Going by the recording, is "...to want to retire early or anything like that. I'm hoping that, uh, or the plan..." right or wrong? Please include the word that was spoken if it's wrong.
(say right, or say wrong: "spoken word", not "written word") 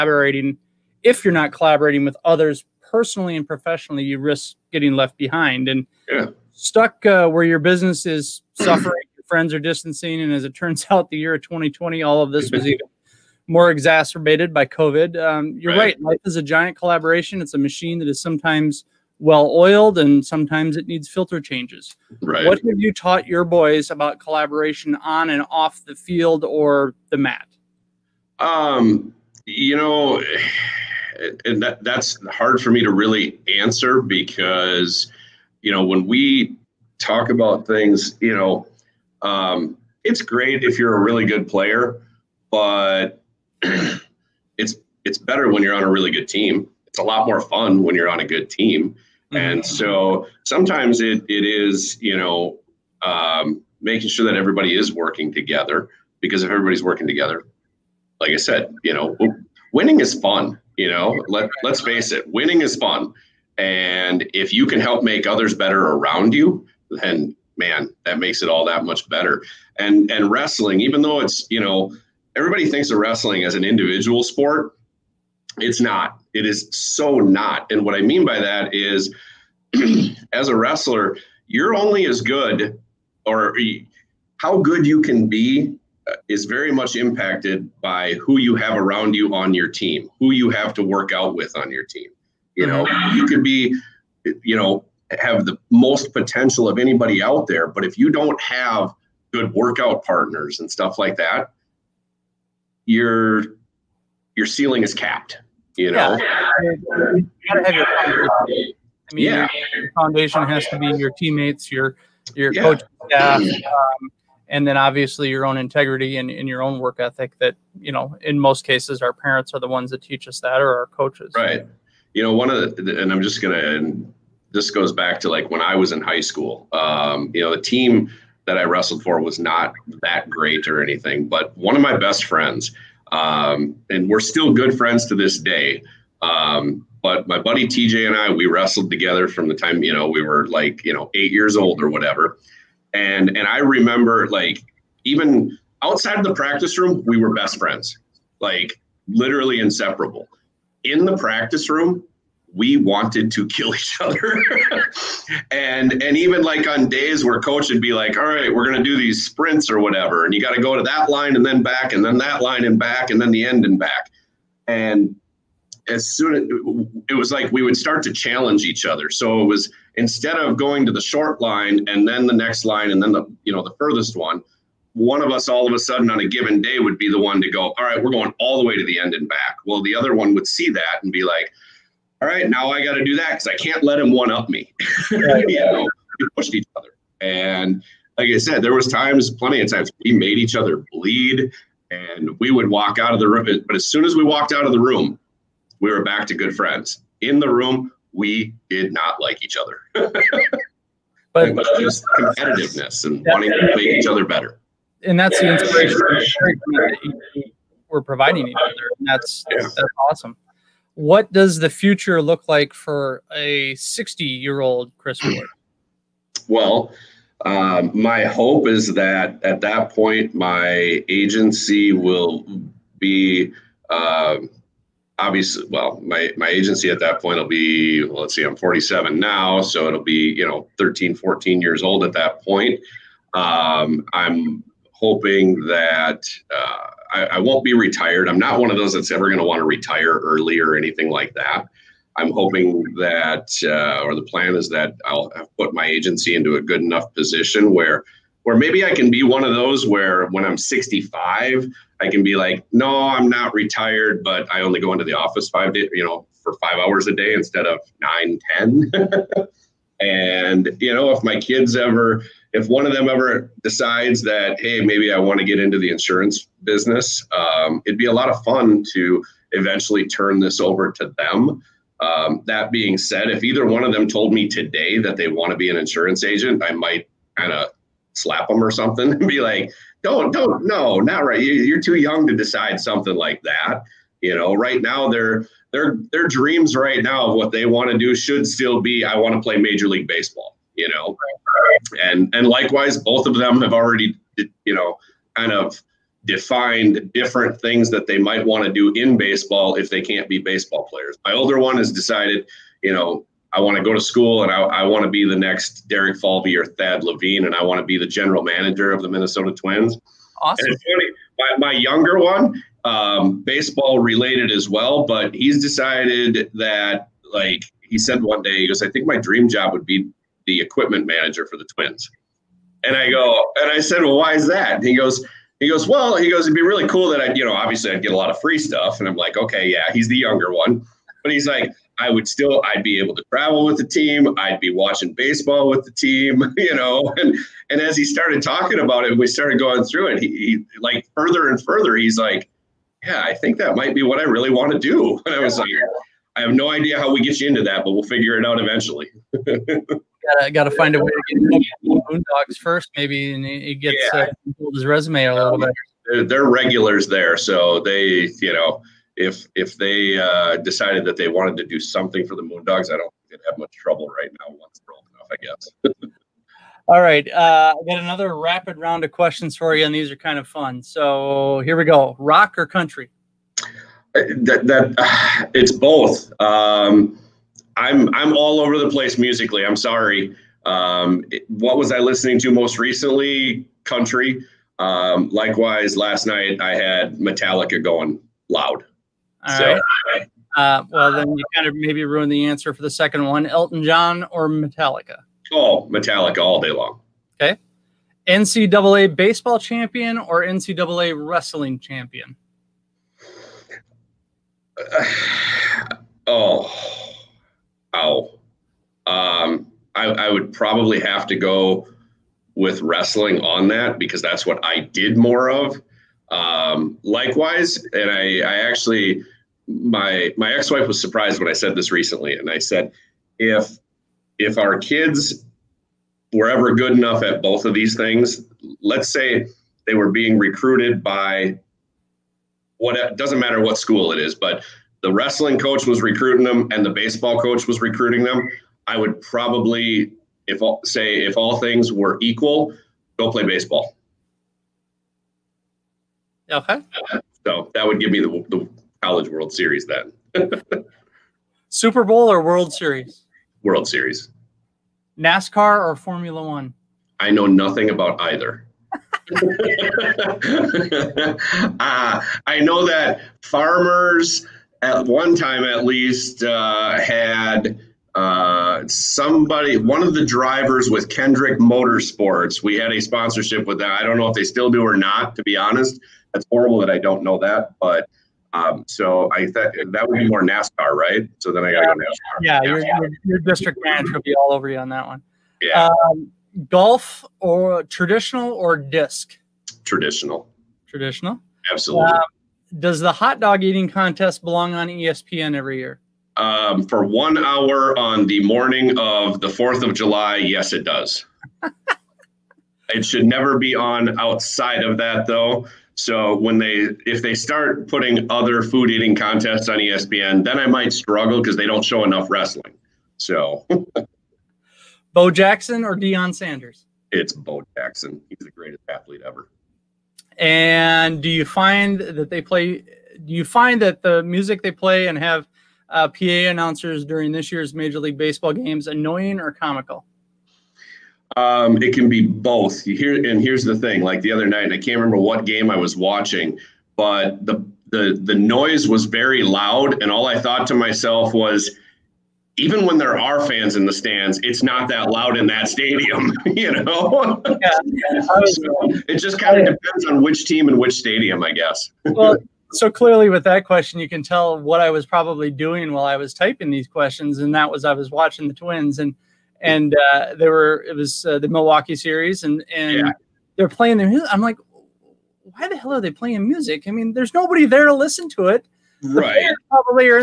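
right.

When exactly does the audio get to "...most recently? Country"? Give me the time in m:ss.
6:22.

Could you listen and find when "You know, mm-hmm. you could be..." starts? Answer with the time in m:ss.
1:32.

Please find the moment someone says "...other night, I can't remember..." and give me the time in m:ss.
8:54.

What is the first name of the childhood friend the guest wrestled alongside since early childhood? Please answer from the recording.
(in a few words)
TJ.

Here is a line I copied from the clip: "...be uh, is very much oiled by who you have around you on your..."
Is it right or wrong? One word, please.
wrong.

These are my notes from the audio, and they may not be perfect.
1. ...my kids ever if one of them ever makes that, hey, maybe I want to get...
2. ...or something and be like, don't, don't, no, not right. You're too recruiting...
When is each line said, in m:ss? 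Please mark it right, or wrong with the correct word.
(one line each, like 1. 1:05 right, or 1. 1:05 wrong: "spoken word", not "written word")
1. 4:21 wrong: "decides", not "makes"
2. 4:38 wrong: "young", not "recruiting".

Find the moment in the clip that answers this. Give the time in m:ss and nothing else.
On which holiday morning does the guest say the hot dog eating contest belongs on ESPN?
8:19.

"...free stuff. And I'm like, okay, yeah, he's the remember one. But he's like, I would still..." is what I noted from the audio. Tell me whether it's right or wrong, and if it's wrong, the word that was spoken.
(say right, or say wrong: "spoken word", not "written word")
wrong: "younger", not "remember".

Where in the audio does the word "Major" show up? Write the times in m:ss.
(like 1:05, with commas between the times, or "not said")
4:49, 8:47.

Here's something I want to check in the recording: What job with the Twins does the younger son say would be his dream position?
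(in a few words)
Equipment manager.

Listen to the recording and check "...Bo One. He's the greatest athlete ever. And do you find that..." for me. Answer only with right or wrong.
wrong.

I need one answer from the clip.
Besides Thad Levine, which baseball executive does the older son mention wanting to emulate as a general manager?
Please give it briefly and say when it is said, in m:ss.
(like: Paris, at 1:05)
Derek Falvey, at 5:05.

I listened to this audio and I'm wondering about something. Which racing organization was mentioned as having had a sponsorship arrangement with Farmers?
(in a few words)
Hendrick Motorsports.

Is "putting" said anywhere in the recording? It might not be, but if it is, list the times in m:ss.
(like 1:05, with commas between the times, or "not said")
8:27.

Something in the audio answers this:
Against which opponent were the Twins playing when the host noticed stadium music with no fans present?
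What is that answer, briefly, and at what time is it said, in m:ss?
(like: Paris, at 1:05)
Milwaukee, at 9:21.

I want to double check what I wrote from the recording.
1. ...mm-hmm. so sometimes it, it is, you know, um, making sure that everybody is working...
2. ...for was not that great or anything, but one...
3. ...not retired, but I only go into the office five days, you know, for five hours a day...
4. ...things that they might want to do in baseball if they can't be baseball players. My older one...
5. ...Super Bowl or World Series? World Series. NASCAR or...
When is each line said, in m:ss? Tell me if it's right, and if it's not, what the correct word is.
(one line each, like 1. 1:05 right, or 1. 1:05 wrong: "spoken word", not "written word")
1. 0:49 right
2. 2:09 right
3. 4:13 right
4. 4:57 right
5. 7:31 right.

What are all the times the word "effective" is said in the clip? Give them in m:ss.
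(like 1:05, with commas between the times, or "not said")
not said.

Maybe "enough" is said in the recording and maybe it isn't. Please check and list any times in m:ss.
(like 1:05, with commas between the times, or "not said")
4:06, 6:05, 7:06, 8:32.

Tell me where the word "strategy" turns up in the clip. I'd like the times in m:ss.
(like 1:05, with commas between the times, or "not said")
not said.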